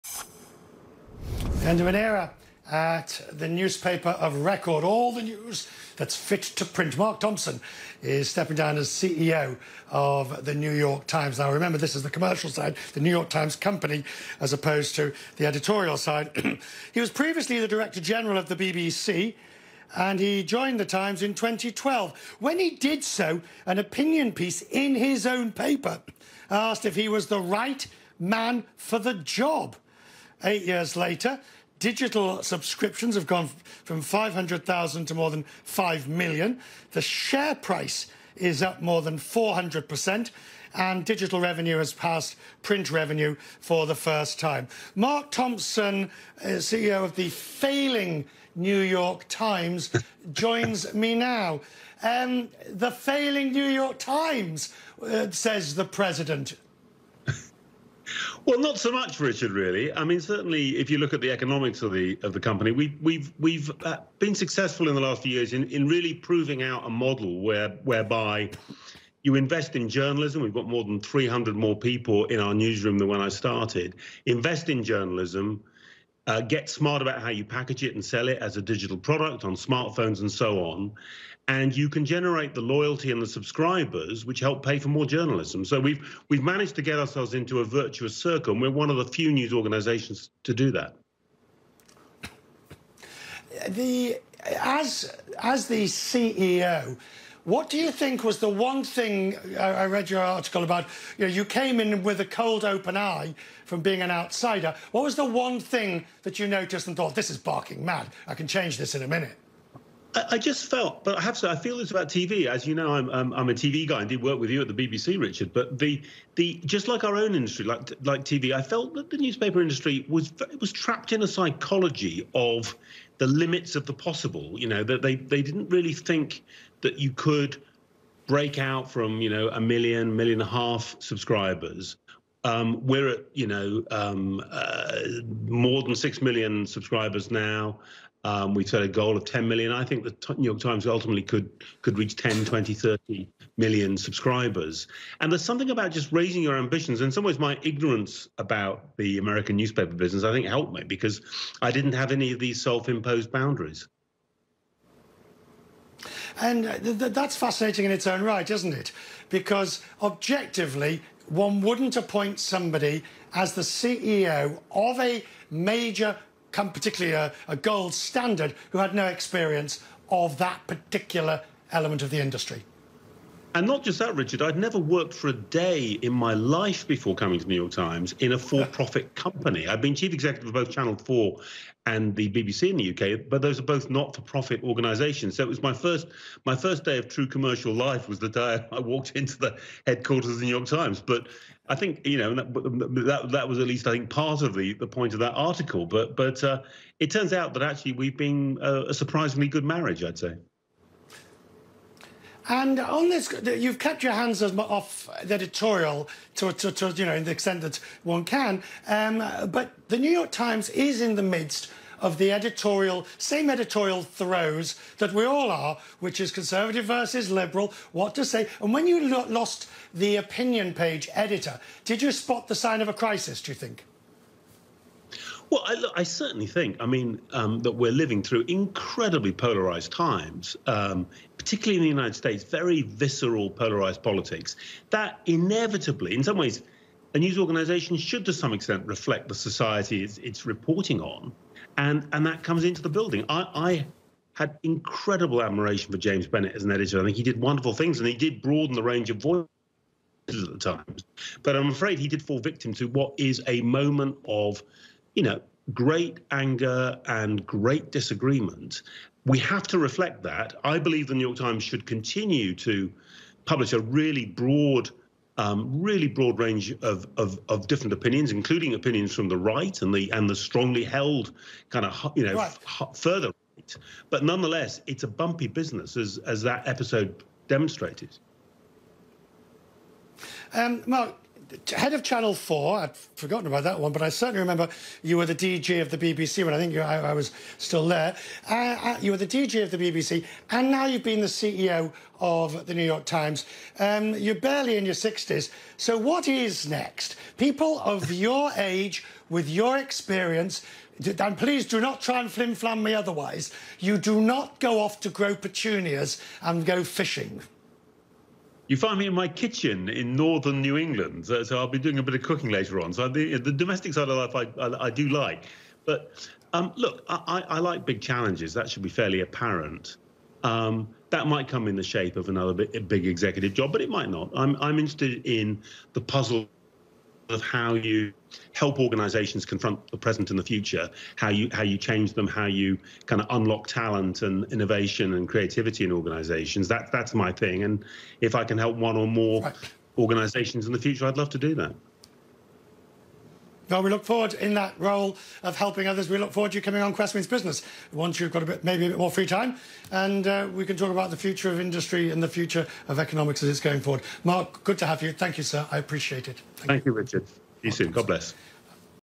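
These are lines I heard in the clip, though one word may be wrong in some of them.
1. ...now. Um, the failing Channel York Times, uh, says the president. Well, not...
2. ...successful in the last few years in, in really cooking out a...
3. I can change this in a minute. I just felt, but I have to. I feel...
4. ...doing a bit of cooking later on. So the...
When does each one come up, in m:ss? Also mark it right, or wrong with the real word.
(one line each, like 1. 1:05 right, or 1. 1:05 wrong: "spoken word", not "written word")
1. 0:51 wrong: "New", not "Channel"
2. 1:04 wrong: "proving", not "cooking"
3. 1:48 right
4. 5:11 right.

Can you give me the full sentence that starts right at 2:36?
And uh, th th that's fascinating in its own right, isn't it?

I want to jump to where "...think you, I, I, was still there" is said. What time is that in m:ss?
4:46.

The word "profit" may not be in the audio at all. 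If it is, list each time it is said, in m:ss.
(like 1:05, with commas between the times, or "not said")
2:58, 3:04.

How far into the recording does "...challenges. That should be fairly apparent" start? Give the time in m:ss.
5:17.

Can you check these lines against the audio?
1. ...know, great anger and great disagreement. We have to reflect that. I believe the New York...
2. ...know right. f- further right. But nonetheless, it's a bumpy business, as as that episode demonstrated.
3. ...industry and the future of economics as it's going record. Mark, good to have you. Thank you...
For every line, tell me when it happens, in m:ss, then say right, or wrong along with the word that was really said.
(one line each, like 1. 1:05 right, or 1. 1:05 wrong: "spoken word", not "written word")
1. 4:15 right
2. 4:32 right
3. 5:51 wrong: "forward", not "record".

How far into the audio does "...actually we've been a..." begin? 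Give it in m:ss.
3:17.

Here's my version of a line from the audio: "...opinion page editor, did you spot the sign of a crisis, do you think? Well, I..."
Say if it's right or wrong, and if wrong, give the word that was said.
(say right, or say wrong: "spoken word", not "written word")
right.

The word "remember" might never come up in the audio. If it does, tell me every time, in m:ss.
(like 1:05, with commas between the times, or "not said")
0:11, 4:44.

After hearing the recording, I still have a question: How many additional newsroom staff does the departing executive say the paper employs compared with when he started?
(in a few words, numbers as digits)
300.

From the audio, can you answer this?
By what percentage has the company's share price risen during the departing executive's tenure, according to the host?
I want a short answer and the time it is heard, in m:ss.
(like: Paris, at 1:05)
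400%, at 0:39.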